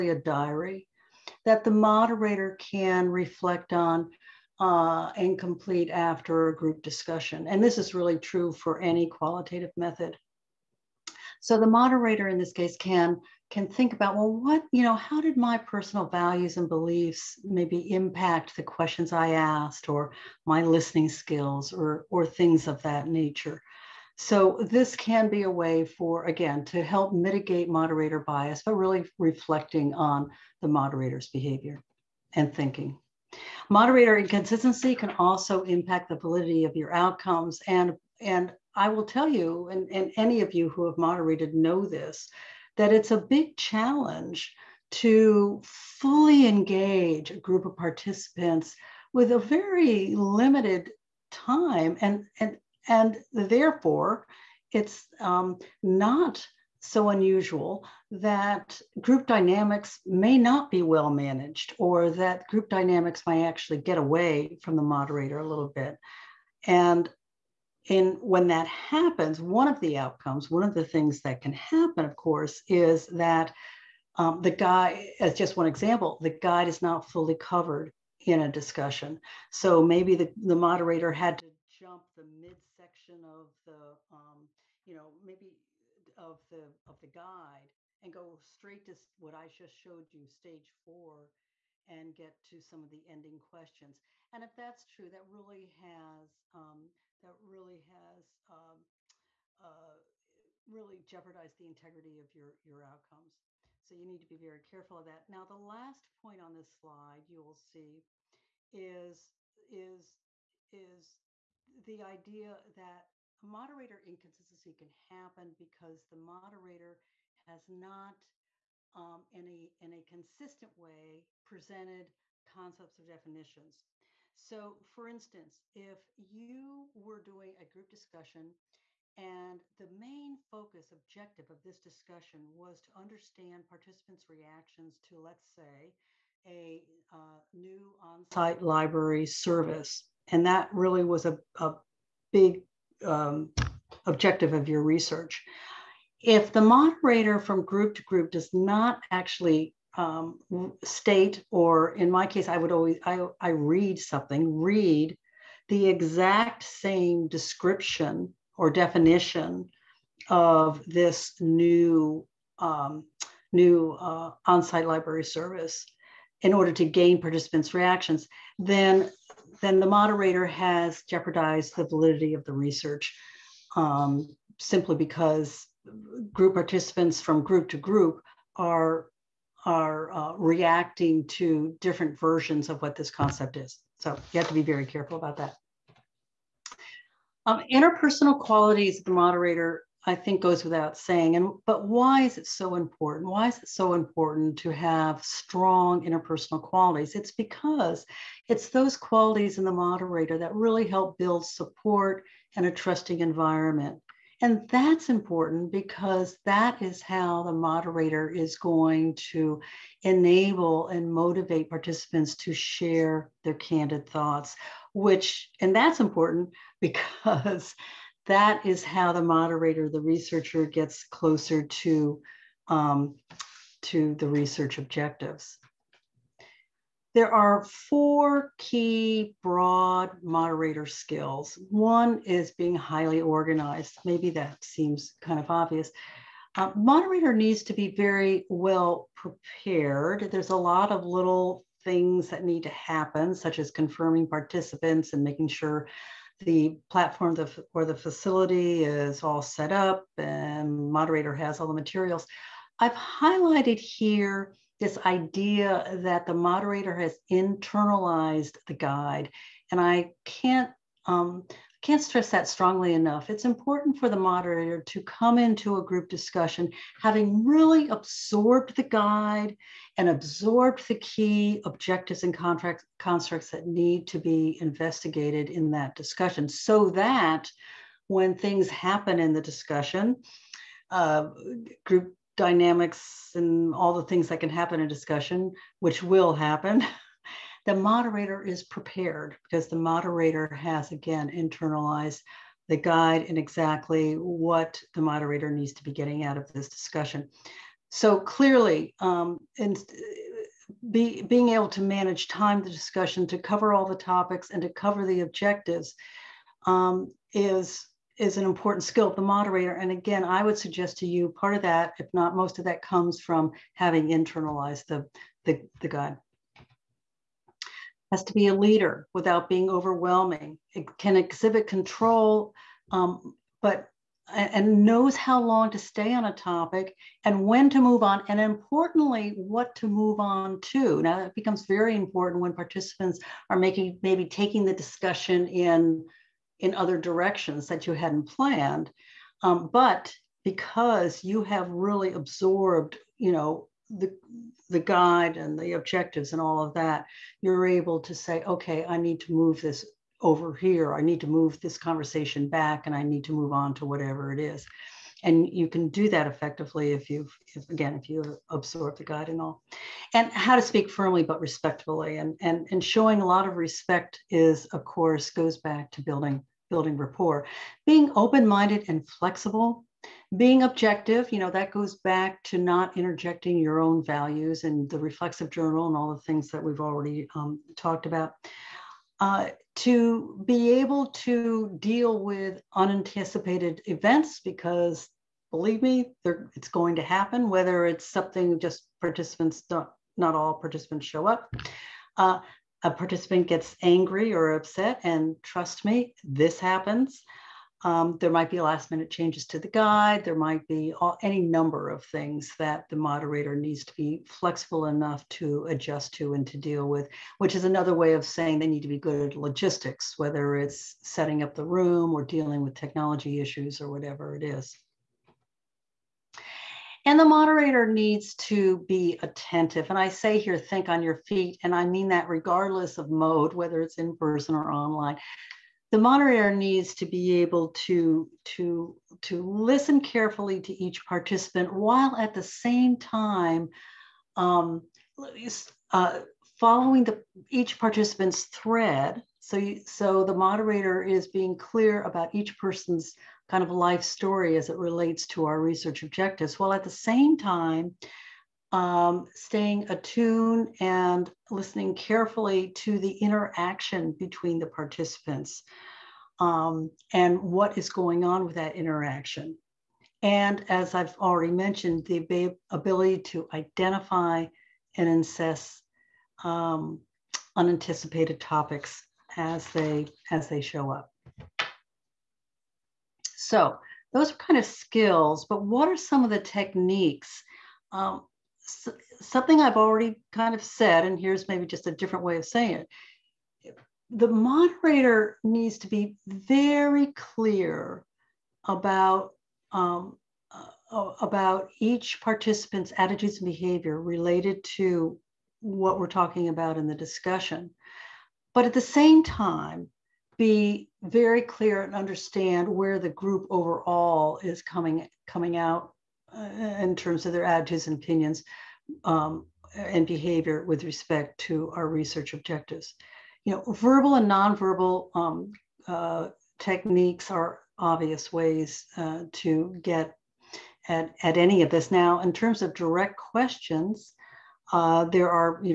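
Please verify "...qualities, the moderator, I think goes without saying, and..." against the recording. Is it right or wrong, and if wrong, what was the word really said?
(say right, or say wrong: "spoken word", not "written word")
right.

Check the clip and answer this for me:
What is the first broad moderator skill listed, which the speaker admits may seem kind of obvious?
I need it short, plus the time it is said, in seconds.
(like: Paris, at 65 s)
being highly organized, at 232 s.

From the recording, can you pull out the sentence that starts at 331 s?
Now, that becomes very important when participants are making maybe taking the discussion in in other directions that you hadn't planned.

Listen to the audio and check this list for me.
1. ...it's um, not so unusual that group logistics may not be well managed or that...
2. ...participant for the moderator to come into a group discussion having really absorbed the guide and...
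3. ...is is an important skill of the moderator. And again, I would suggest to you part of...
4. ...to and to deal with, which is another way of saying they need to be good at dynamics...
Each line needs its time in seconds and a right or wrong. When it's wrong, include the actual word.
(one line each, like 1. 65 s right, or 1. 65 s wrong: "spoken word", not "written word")
1. 54 s wrong: "dynamics", not "logistics"
2. 263 s wrong: "important", not "participant"
3. 307 s right
4. 406 s wrong: "logistics", not "dynamics".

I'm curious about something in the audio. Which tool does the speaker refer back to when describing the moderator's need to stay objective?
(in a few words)
reflexive journal.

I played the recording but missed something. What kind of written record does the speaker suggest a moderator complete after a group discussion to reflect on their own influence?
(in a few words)
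diary.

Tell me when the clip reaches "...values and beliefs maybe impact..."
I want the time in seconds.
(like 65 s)
16 s.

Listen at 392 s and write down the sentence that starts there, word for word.
Uh, a participant gets angry or upset, and trust me, this happens.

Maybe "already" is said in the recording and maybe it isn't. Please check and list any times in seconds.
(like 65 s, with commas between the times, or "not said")
376 s, 461 s, 479 s.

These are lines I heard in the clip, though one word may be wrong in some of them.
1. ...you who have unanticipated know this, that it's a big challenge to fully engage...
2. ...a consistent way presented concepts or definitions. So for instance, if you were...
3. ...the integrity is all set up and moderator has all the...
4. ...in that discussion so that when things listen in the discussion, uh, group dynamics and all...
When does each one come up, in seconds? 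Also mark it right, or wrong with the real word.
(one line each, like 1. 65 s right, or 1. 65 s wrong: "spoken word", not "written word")
1. 40 s wrong: "moderated", not "unanticipated"
2. 119 s right
3. 247 s wrong: "facility", not "integrity"
4. 275 s wrong: "happen", not "listen".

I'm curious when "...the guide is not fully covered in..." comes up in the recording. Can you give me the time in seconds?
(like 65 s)
76 s.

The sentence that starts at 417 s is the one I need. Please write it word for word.
And the moderator needs to be attentive.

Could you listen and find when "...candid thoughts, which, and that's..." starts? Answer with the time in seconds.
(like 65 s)
213 s.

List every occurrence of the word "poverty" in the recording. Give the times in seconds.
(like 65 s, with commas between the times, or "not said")
not said.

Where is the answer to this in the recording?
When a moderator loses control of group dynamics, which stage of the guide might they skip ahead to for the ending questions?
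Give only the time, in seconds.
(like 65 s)
90 s.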